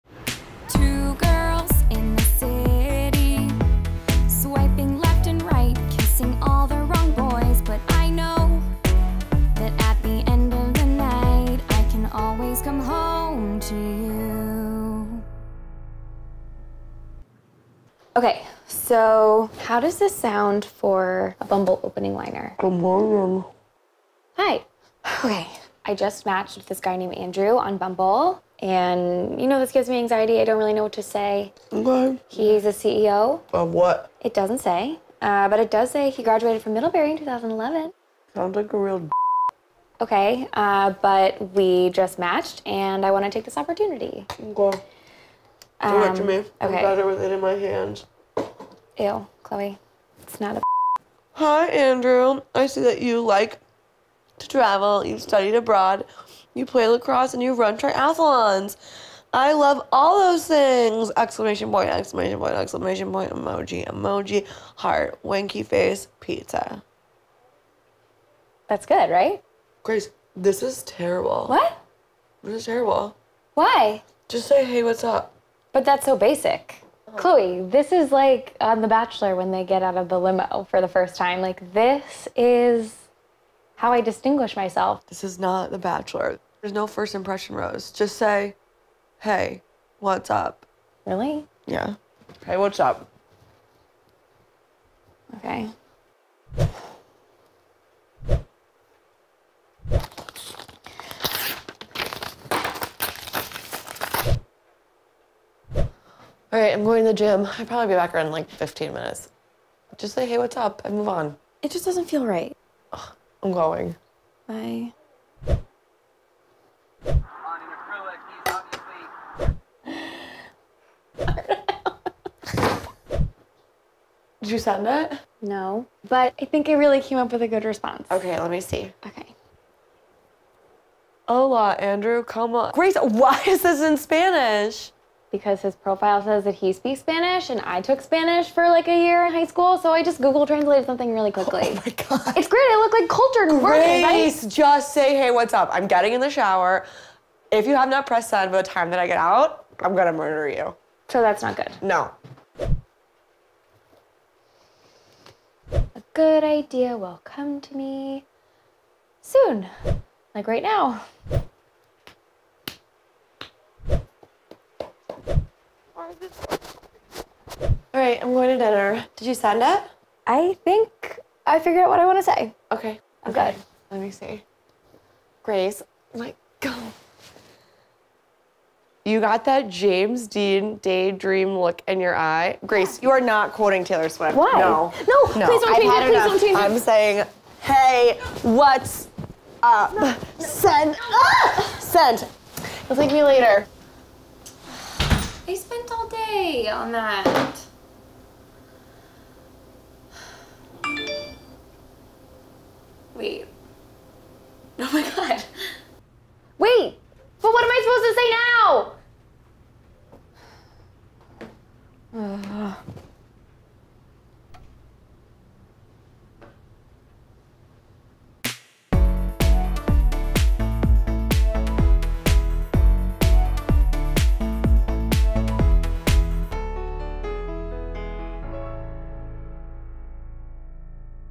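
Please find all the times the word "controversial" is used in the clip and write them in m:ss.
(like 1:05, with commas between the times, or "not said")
not said.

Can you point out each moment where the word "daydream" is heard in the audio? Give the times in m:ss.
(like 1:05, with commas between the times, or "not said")
3:00.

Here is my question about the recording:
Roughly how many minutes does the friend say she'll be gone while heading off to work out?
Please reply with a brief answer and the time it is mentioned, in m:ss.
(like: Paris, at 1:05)
15, at 1:48.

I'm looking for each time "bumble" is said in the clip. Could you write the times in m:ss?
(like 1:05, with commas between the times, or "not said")
0:21, 0:27.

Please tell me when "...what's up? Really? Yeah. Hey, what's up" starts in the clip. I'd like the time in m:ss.
1:29.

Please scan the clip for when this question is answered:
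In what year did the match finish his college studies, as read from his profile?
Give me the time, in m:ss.
0:37.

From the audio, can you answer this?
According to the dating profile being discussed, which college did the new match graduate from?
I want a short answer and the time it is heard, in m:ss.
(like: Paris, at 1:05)
Middlebury, at 0:36.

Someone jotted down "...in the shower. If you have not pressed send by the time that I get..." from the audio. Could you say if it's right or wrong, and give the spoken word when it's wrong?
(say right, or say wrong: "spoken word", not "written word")
right.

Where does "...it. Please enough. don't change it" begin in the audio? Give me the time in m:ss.
3:05.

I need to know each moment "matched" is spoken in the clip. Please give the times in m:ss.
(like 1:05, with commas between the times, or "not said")
0:26, 0:42.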